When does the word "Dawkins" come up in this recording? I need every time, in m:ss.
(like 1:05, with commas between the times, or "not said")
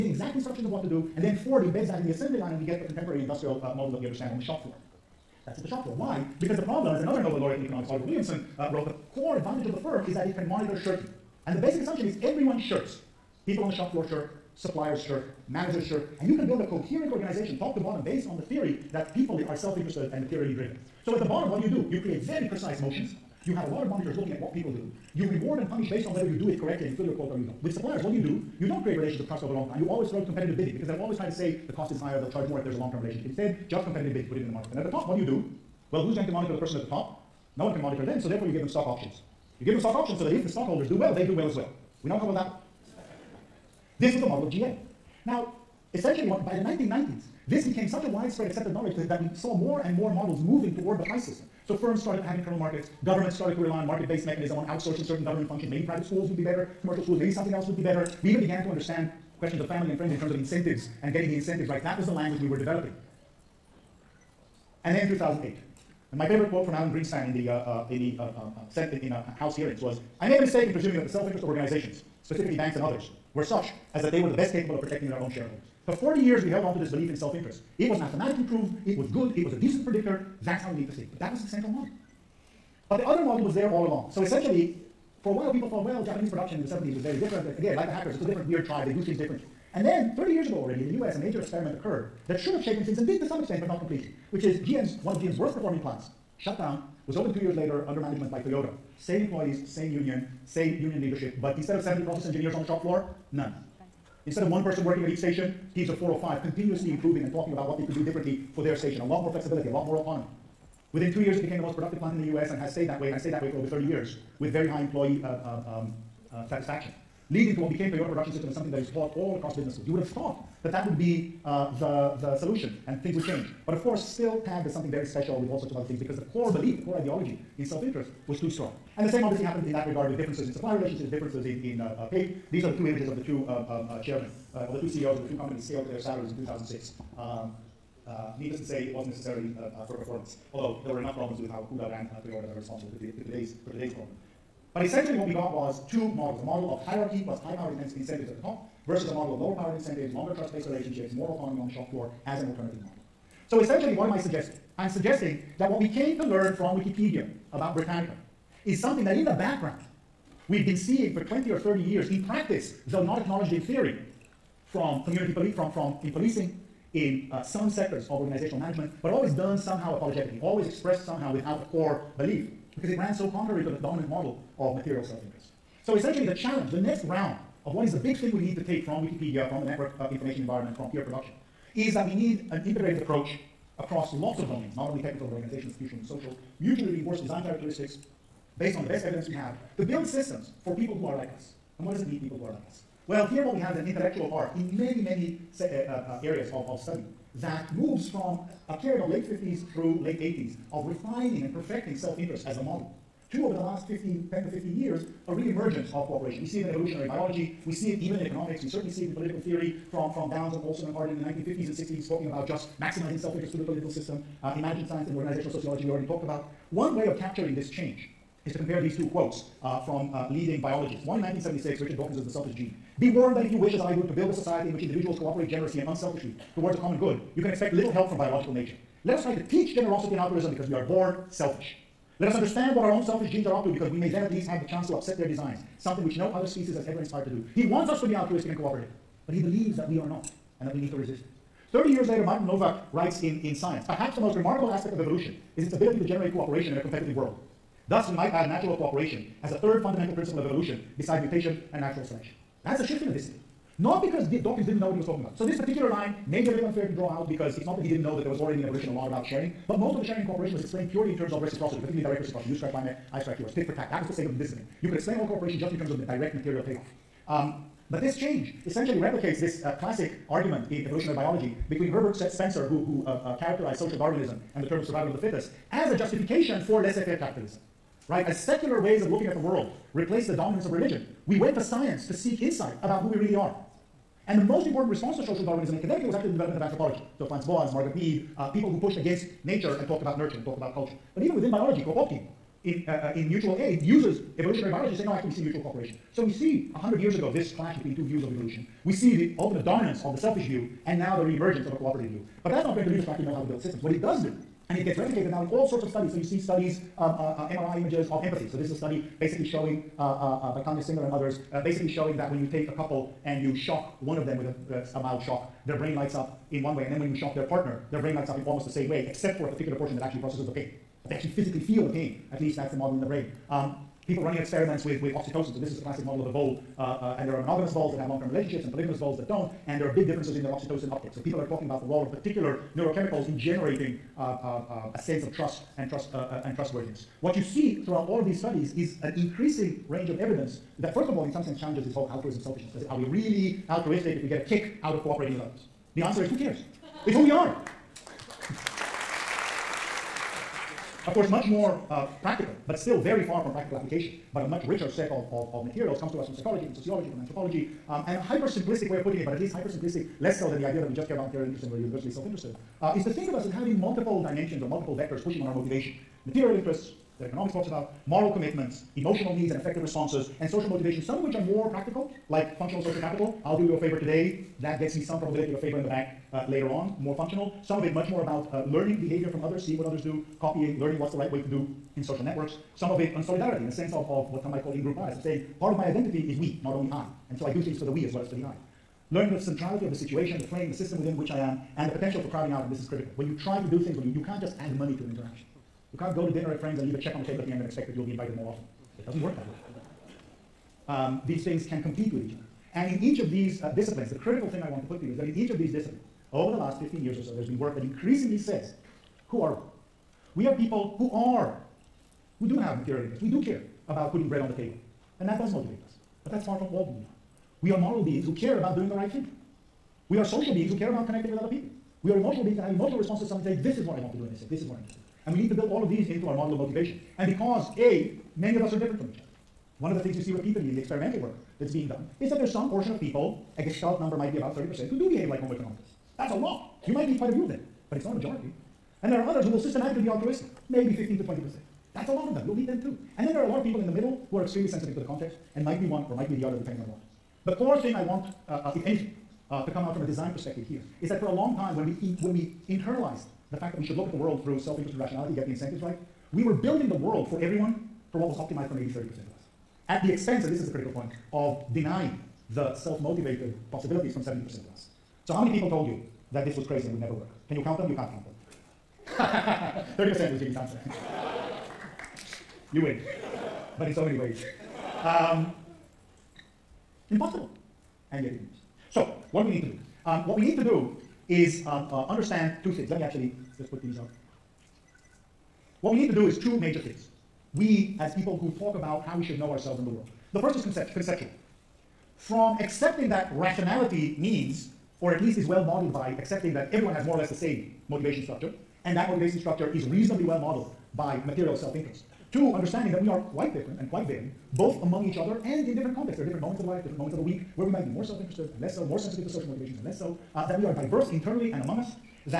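3:41, 4:14.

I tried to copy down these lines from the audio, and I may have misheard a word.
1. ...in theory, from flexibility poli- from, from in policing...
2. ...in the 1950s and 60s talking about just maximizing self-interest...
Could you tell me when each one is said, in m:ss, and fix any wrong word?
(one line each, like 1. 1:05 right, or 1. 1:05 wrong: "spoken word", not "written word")
1. 2:43 wrong: "community", not "flexibility"
2. 3:31 right.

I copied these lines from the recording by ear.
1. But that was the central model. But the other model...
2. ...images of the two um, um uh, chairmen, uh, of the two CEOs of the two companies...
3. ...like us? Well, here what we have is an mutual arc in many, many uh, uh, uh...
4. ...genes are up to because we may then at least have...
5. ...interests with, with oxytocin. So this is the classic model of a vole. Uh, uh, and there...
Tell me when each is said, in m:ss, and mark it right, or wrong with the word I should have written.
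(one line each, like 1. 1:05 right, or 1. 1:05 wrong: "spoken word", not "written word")
1. 1:21 right
2. 2:12 right
3. 3:12 wrong: "intellectual", not "mutual"
4. 3:53 right
5. 5:24 wrong: "experiments", not "interests".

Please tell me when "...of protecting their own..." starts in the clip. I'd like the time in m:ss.
1:14.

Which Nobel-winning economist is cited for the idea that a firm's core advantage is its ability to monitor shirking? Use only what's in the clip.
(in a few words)
Oliver Williamson.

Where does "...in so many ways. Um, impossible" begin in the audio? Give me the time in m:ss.
7:53.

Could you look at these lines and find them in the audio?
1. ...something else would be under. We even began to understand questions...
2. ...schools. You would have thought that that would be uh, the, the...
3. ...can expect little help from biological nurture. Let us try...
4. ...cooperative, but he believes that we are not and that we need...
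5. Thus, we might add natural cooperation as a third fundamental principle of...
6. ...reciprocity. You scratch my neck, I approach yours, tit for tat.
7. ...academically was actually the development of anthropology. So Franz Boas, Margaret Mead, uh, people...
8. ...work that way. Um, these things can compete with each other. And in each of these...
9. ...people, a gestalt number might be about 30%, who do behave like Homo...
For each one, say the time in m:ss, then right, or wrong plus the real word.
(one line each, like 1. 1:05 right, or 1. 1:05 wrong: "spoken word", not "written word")
1. 0:57 wrong: "better", not "under"
2. 1:59 right
3. 3:47 wrong: "nature", not "nurture"
4. 3:58 right
5. 4:07 right
6. 4:22 wrong: "scratch", not "approach"
7. 4:45 right
8. 6:39 right
9. 7:13 right.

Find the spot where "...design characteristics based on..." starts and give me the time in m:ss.
3:07.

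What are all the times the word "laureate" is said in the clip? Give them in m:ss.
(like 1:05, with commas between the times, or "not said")
0:07.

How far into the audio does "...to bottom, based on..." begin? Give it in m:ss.
0:17.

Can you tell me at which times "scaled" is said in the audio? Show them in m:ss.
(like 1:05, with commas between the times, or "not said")
2:15.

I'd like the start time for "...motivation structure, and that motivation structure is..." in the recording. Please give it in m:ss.
8:17.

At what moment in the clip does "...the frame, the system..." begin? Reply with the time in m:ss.
6:30.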